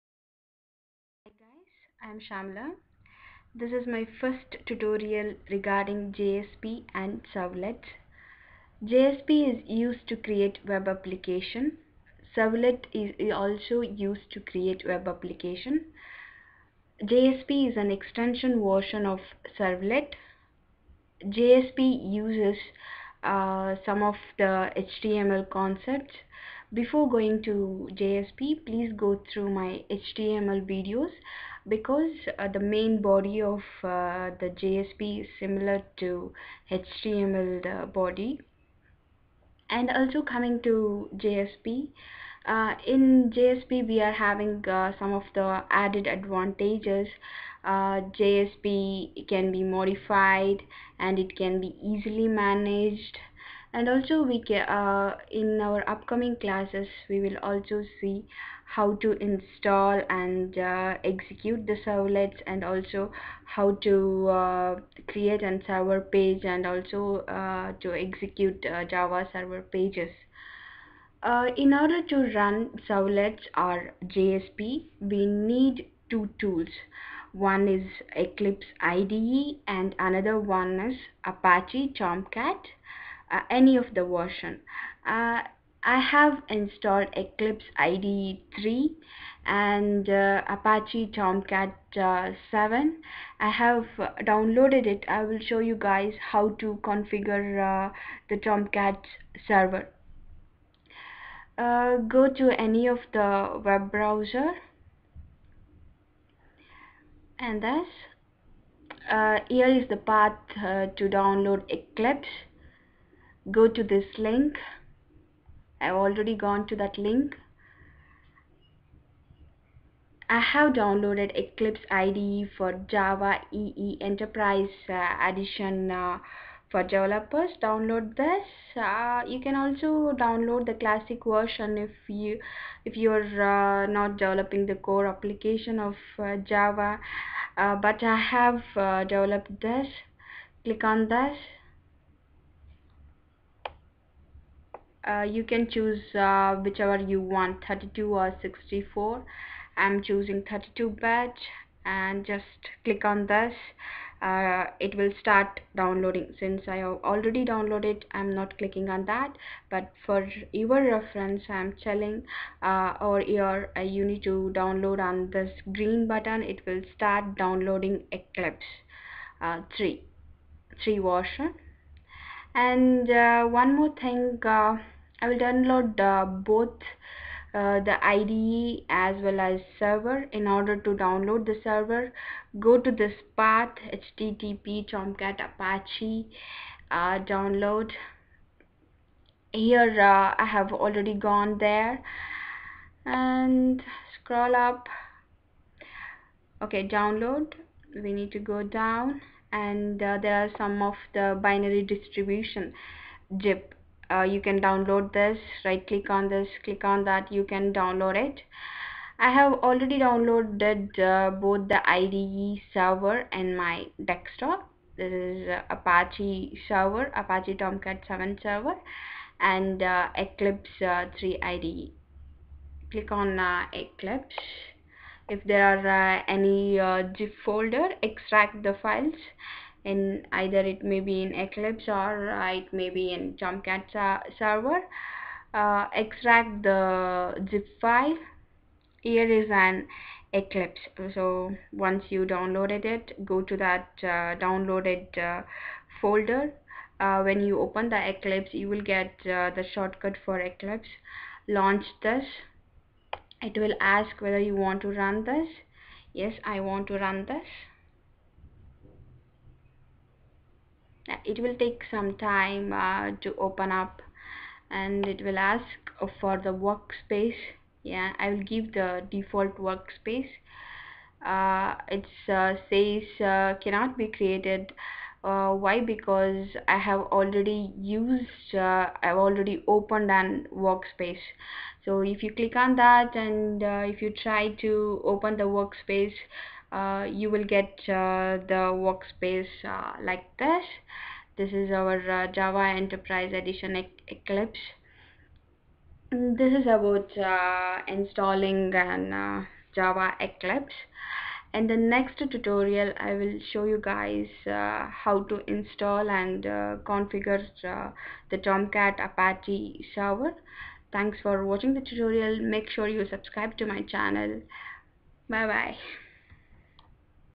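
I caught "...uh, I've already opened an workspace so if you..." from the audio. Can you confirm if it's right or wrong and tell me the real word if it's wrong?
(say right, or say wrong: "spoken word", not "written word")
right.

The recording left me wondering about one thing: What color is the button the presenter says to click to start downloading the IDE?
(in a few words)
green.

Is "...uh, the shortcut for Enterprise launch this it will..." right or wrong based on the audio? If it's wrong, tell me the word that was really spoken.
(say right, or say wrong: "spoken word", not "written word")
wrong: "Eclipse", not "Enterprise".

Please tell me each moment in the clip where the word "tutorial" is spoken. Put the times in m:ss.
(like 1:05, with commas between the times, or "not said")
0:04, 5:02, 5:11.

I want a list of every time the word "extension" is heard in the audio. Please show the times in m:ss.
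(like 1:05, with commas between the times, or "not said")
0:17.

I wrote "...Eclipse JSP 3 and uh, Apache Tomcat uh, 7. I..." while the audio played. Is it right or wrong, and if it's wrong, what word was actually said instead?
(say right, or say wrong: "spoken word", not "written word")
wrong: "IDE", not "JSP".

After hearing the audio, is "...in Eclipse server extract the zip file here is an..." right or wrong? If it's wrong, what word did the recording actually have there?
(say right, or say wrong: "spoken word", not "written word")
wrong: "Tomcat", not "Eclipse".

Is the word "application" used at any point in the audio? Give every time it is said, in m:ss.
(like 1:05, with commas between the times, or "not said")
0:10, 0:15, 2:15.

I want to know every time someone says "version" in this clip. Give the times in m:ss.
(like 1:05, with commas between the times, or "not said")
0:18, 1:24, 2:11, 2:50.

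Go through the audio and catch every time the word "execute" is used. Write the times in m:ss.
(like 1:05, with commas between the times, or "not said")
1:01, 1:07.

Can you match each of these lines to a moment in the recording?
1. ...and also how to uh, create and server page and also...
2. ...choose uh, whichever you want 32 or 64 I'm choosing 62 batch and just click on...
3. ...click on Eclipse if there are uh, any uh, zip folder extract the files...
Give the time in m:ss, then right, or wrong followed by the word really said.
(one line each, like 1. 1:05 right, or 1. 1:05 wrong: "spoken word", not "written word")
1. 1:02 right
2. 2:25 wrong: "32", not "62"
3. 3:42 right.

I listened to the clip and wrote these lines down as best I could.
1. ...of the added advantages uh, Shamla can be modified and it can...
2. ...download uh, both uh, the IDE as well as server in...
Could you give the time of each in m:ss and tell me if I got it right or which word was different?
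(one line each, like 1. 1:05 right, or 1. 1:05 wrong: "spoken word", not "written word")
1. 0:45 wrong: "JSP", not "Shamla"
2. 2:55 right.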